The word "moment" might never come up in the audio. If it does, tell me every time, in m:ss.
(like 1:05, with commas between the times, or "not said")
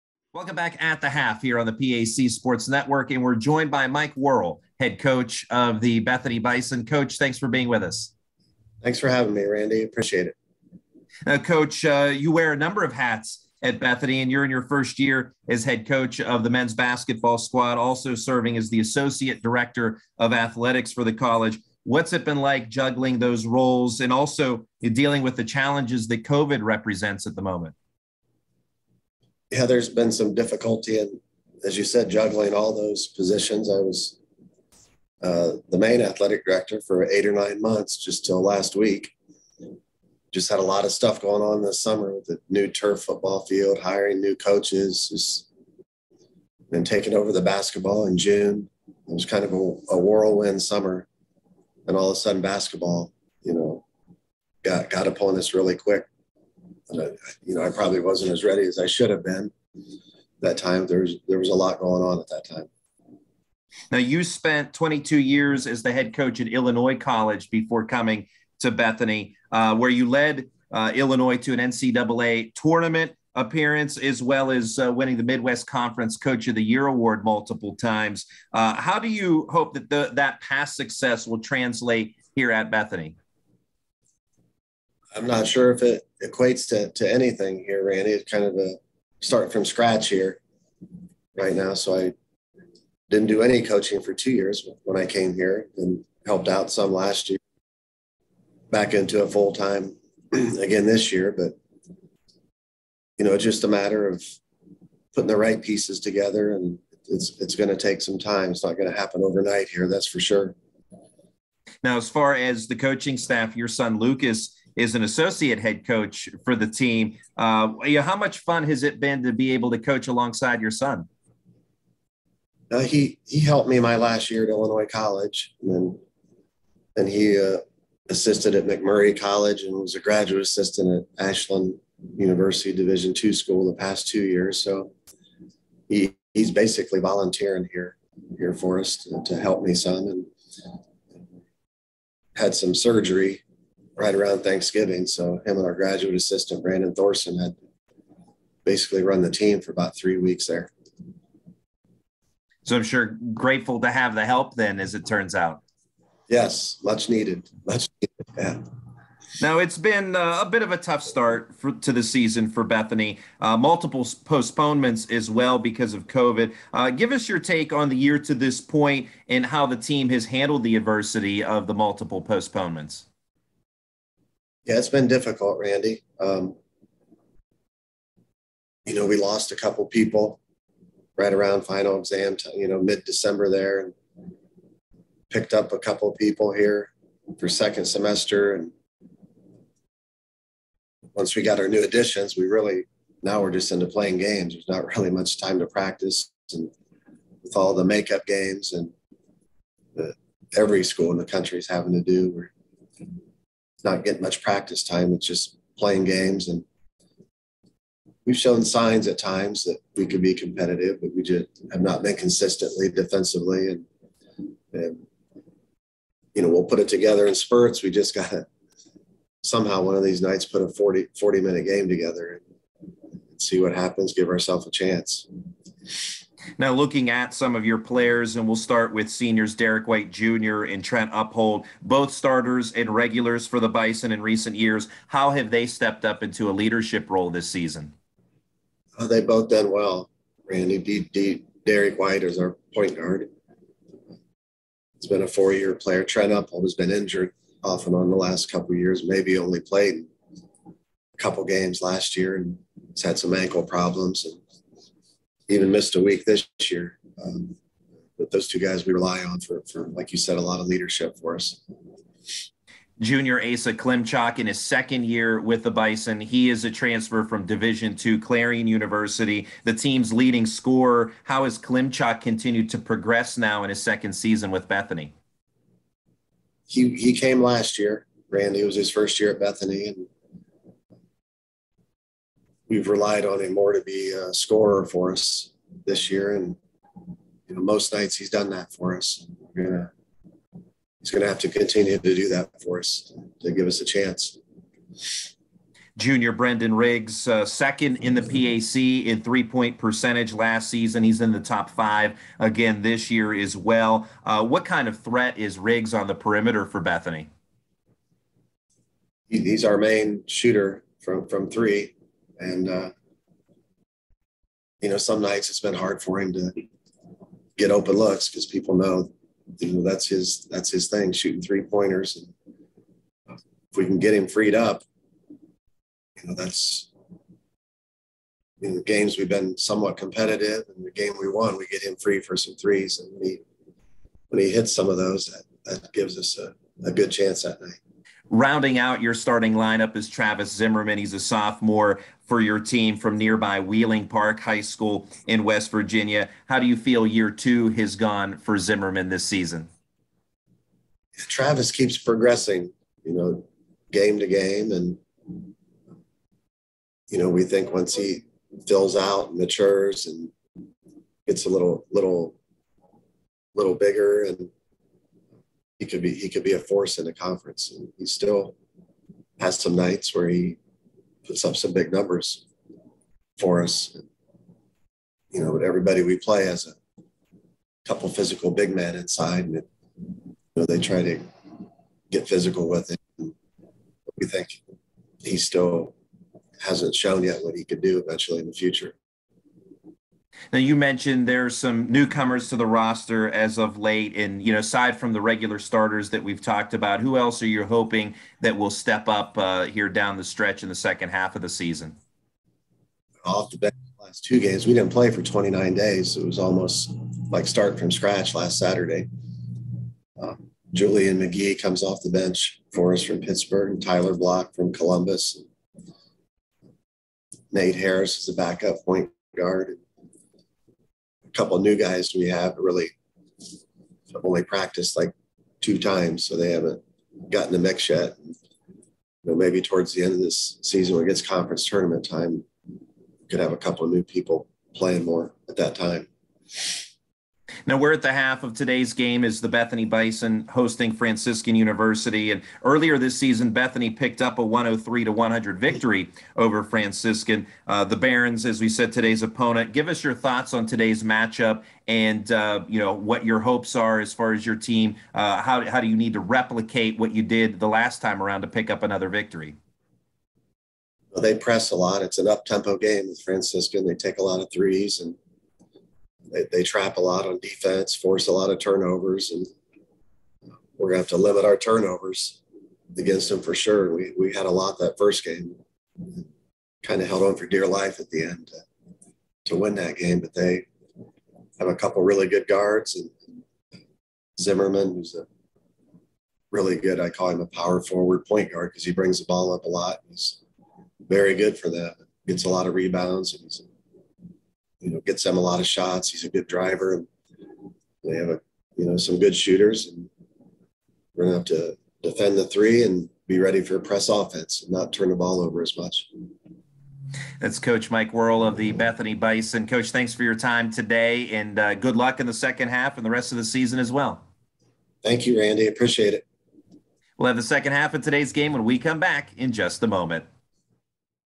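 0:27, 8:39.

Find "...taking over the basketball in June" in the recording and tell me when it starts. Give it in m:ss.
0:46.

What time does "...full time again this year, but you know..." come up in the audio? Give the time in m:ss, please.
1:39.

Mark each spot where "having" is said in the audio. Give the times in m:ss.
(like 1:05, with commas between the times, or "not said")
0:09, 3:21.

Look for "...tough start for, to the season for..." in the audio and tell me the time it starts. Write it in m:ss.
2:40.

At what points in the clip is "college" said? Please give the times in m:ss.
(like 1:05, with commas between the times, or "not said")
0:21, 1:06, 2:04, 2:09.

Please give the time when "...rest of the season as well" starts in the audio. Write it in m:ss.
8:33.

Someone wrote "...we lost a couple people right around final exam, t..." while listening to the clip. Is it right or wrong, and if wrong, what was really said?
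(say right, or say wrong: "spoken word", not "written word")
right.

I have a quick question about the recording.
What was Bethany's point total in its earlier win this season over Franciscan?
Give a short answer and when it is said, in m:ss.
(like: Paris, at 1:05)
103, at 7:24.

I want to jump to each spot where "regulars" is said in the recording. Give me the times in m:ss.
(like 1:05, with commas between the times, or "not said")
3:52, 6:35.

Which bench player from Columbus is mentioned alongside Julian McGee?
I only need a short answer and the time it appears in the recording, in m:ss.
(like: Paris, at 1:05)
Tyler Block, at 6:53.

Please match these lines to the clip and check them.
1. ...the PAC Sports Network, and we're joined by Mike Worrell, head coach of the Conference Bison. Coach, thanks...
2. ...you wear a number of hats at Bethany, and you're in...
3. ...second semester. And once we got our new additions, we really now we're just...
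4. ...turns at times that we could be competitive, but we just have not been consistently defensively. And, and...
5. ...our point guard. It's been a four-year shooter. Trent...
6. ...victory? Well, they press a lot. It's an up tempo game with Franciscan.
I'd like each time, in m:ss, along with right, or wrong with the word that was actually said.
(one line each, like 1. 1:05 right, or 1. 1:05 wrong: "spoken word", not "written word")
1. 0:01 wrong: "Bethany", not "Conference"
2. 0:12 right
3. 3:07 right
4. 3:28 wrong: "signs", not "turns"
5. 4:02 wrong: "player", not "shooter"
6. 7:39 right.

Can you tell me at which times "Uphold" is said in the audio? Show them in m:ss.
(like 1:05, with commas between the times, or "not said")
3:51, 4:06.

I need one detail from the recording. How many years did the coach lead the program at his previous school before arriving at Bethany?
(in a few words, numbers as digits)
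22.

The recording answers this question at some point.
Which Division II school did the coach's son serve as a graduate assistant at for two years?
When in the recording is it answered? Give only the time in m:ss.
2:11.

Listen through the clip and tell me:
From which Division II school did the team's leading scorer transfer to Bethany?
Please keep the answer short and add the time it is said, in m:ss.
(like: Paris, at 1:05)
Clarion University, at 4:28.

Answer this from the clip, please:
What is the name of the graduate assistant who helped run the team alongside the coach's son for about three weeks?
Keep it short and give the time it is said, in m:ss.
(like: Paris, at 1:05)
Brandon Thorson, at 2:26.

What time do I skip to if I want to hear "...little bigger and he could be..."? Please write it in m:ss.
6:03.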